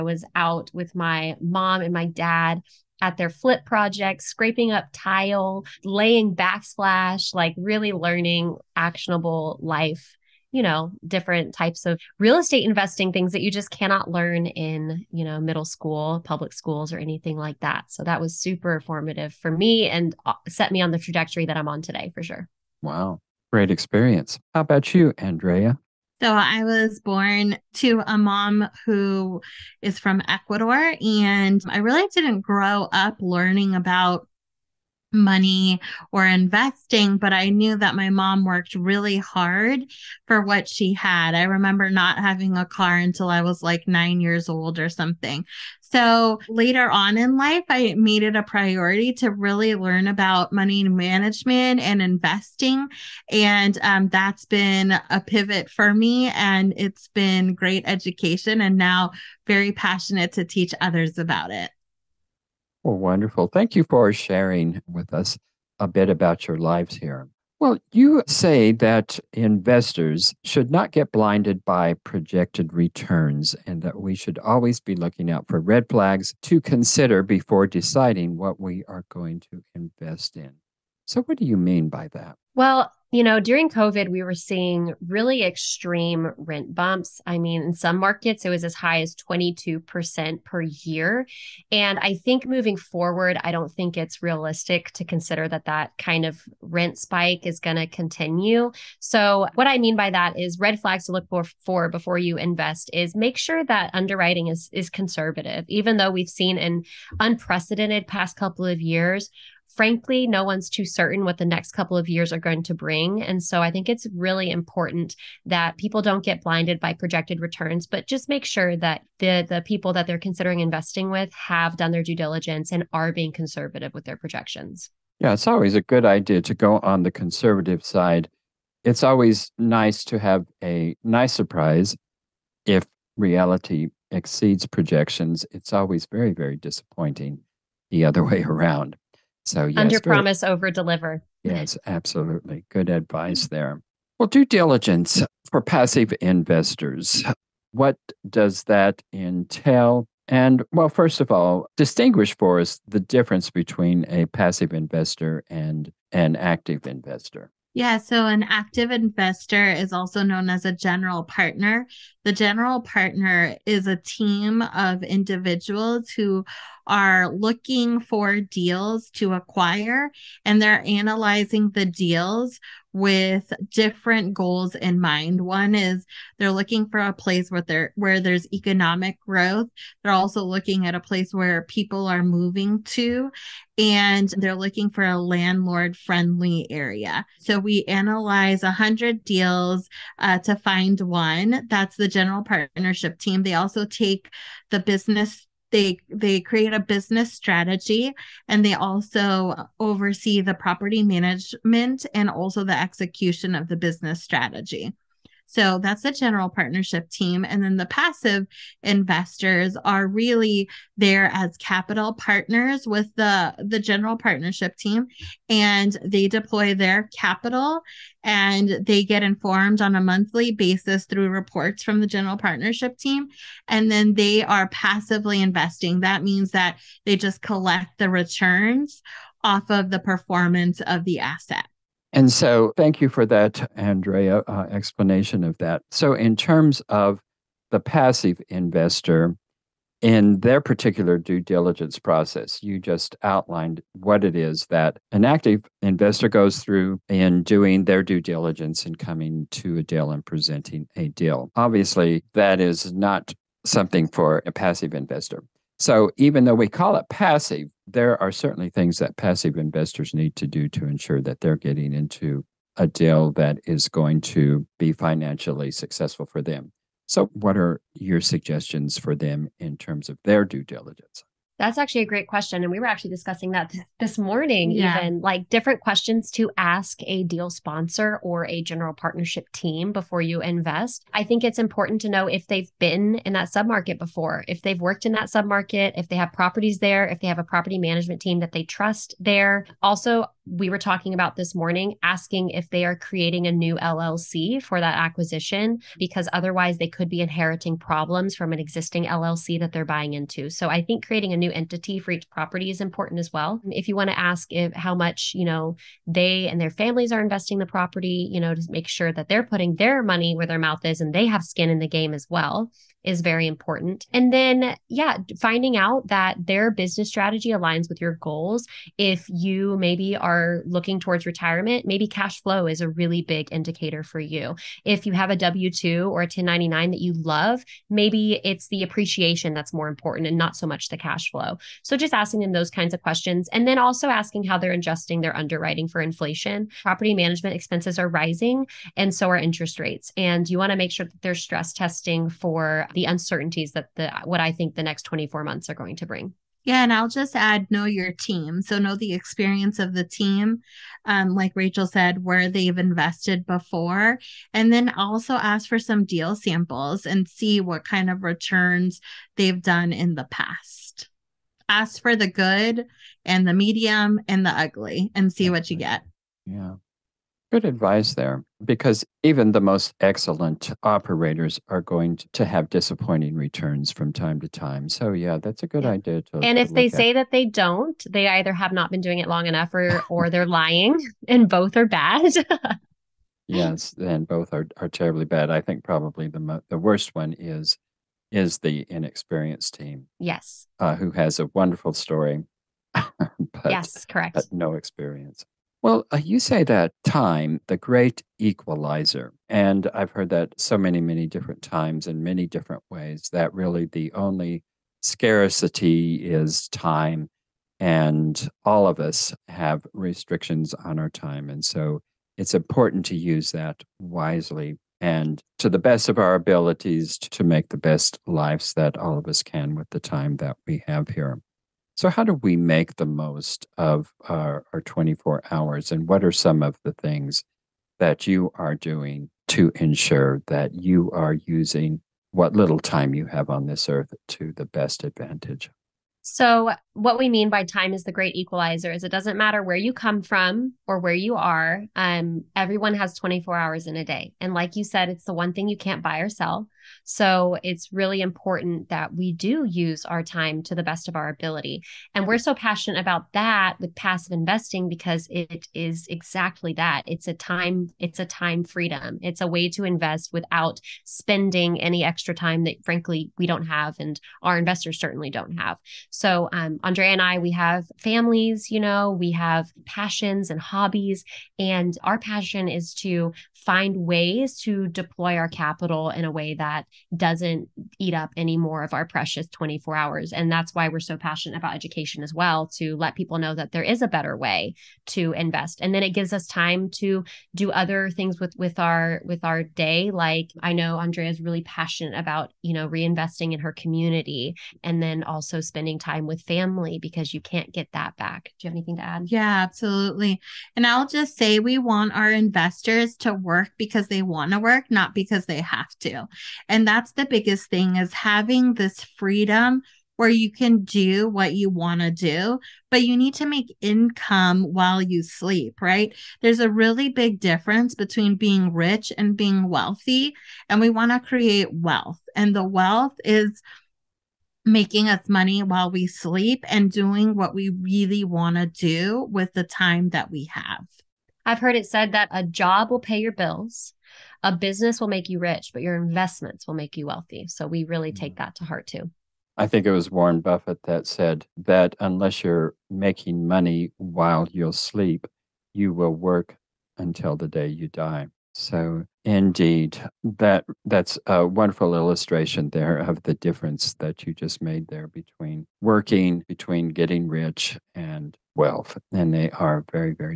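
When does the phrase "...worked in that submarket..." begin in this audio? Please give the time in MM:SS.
04:44.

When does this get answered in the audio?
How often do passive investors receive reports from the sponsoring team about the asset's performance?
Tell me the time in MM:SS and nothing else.
03:40.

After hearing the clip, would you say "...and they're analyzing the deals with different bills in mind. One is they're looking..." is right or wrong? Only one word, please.
wrong.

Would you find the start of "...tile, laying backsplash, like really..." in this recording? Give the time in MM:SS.
00:04.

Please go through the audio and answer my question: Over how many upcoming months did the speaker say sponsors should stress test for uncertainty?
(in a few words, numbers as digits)
24.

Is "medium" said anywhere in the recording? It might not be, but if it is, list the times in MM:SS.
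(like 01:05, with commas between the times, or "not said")
06:03.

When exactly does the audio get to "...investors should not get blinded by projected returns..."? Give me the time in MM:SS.
01:09.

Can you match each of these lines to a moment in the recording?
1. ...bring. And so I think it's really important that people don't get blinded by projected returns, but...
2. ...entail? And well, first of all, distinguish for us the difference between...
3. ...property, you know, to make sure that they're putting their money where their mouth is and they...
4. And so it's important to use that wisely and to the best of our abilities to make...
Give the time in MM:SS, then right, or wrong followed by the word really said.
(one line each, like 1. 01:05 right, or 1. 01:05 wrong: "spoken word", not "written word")
1. 01:52 right
2. 02:29 right
3. 05:07 right
4. 06:51 right.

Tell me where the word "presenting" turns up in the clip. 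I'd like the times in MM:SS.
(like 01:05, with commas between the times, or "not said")
04:10.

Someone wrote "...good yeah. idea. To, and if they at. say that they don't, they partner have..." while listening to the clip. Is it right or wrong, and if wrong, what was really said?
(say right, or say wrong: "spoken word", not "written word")
wrong: "either", not "partner".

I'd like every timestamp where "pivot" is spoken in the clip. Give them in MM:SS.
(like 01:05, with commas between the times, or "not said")
00:55.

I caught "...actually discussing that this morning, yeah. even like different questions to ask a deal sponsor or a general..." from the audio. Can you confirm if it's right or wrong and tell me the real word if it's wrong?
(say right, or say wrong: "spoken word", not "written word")
right.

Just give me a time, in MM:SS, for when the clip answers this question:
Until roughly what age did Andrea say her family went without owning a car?
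00:43.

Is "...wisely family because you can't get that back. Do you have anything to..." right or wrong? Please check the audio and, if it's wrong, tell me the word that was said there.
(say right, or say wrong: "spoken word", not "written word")
wrong: "family", not "wisely".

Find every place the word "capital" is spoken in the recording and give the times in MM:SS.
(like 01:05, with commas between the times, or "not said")
03:31, 03:37, 07:55.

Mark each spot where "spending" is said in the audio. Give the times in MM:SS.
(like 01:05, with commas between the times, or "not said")
07:41, 08:15.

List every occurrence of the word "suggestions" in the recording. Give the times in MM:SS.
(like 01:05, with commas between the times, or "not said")
04:28.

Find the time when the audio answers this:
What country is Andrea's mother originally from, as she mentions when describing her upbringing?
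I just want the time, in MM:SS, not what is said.
00:30.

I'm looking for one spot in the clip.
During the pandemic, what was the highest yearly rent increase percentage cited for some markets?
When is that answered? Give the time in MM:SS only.
01:29.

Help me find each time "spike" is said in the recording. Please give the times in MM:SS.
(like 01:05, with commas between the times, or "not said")
01:36.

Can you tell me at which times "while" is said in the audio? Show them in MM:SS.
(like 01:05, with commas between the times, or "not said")
08:34, 08:45, 09:03.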